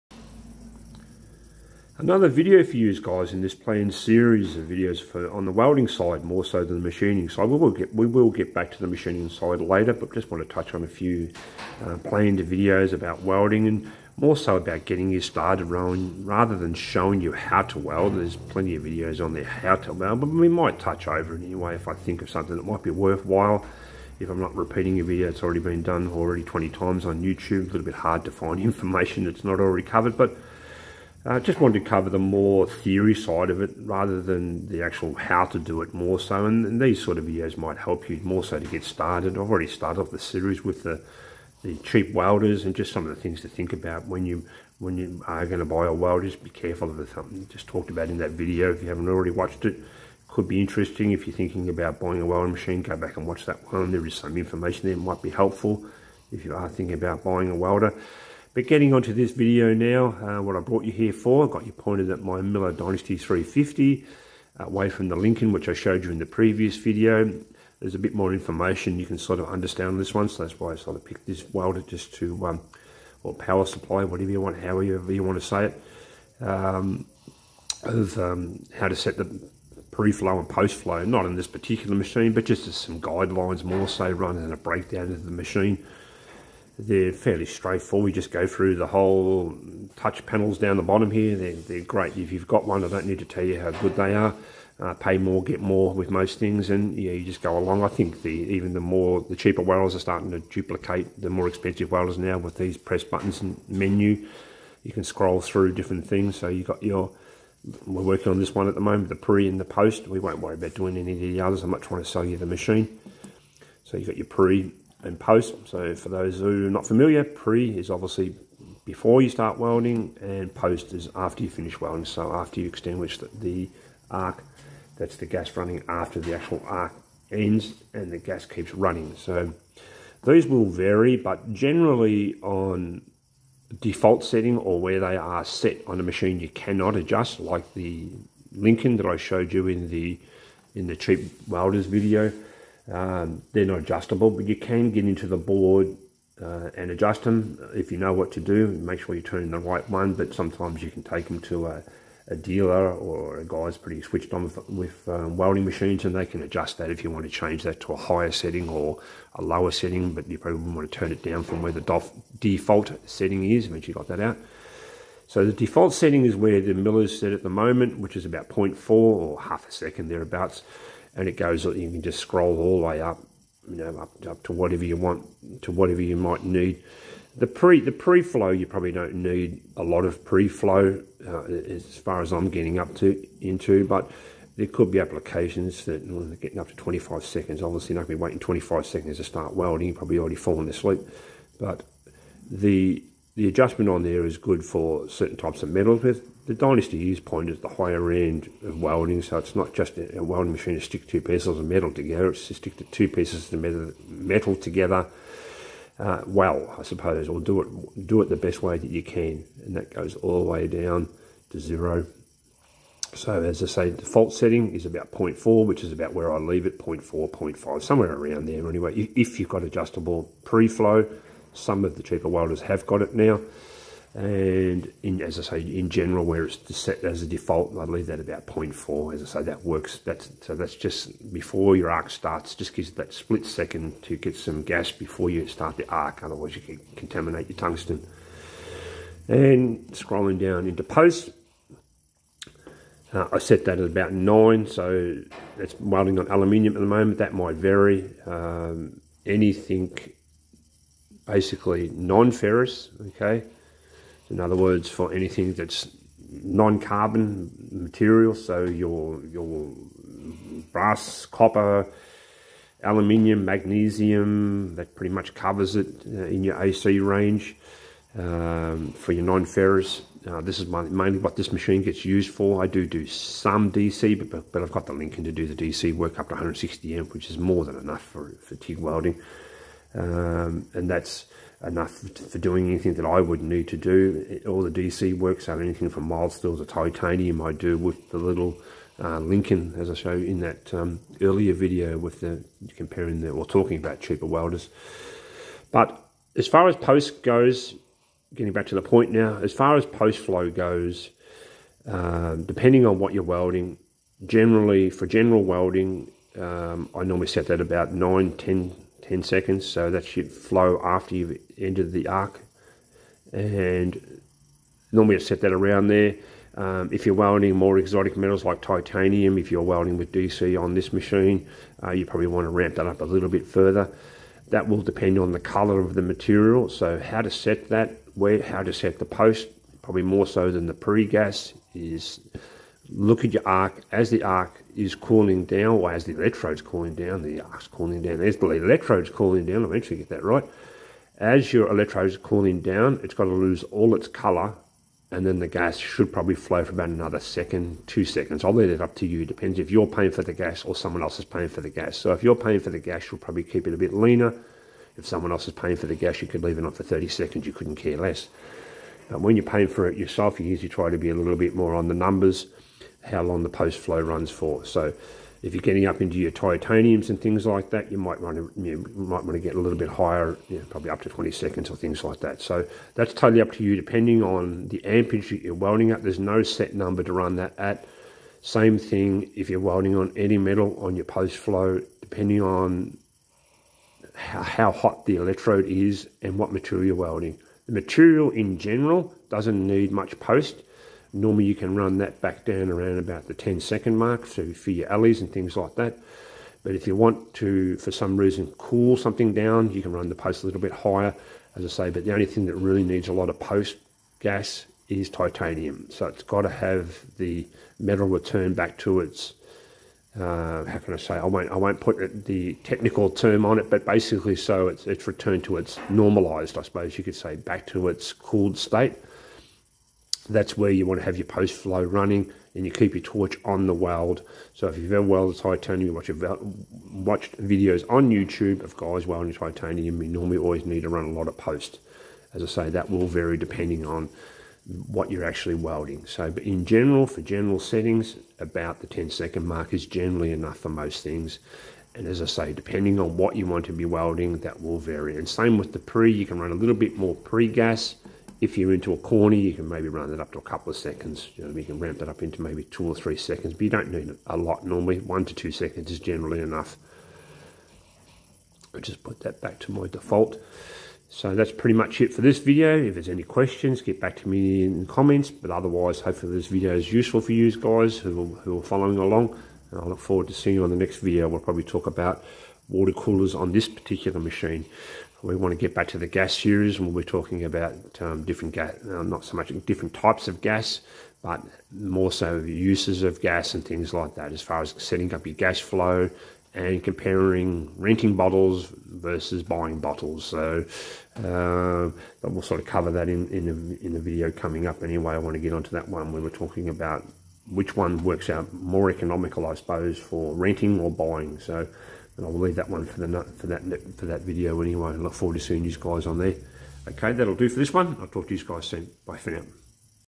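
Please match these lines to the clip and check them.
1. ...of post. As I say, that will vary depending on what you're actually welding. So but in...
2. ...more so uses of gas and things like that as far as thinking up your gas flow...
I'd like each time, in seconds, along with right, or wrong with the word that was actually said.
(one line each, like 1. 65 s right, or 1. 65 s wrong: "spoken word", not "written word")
1. 431 s right
2. 481 s wrong: "setting", not "thinking".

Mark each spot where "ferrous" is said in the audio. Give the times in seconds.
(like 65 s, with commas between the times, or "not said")
251 s, 269 s.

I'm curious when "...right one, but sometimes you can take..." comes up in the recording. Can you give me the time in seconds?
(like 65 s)
149 s.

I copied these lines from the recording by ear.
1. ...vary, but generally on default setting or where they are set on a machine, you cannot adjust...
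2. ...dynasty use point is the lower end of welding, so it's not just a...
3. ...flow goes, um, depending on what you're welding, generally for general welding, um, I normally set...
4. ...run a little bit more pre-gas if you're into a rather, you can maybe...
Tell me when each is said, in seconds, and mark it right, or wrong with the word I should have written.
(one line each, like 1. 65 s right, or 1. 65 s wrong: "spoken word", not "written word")
1. 130 s right
2. 196 s wrong: "higher", not "lower"
3. 300 s right
4. 446 s wrong: "corner", not "rather".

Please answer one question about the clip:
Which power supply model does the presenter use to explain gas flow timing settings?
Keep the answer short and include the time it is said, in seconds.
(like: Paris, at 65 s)
Miller Dynasty 350, at 62 s.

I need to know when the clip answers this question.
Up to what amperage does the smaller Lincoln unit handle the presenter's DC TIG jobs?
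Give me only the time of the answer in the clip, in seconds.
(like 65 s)
276 s.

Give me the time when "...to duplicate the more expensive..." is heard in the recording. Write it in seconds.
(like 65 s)
100 s.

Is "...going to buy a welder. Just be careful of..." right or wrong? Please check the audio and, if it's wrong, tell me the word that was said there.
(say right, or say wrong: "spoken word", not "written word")
right.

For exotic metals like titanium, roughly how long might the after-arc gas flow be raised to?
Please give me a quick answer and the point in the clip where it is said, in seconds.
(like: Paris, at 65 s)
20 seconds, at 371 s.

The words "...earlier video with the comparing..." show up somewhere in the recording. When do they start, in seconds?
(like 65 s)
291 s.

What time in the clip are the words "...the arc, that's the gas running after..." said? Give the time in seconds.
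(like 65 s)
123 s.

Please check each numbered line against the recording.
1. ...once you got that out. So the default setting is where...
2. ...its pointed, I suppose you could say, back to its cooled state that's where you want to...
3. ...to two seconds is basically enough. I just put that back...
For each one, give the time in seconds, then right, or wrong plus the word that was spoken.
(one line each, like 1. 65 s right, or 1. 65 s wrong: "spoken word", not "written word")
1. 163 s right
2. 415 s wrong: "normalized", not "pointed"
3. 455 s wrong: "generally", not "basically".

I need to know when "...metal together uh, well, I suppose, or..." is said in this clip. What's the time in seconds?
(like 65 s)
204 s.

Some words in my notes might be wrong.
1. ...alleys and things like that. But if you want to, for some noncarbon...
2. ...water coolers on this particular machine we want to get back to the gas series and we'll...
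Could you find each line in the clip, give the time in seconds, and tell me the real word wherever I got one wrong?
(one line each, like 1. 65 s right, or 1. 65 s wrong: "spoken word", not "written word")
1. 394 s wrong: "reason", not "noncarbon"
2. 472 s right.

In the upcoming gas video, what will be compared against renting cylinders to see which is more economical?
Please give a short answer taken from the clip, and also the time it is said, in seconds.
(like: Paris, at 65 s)
buying bottles, at 489 s.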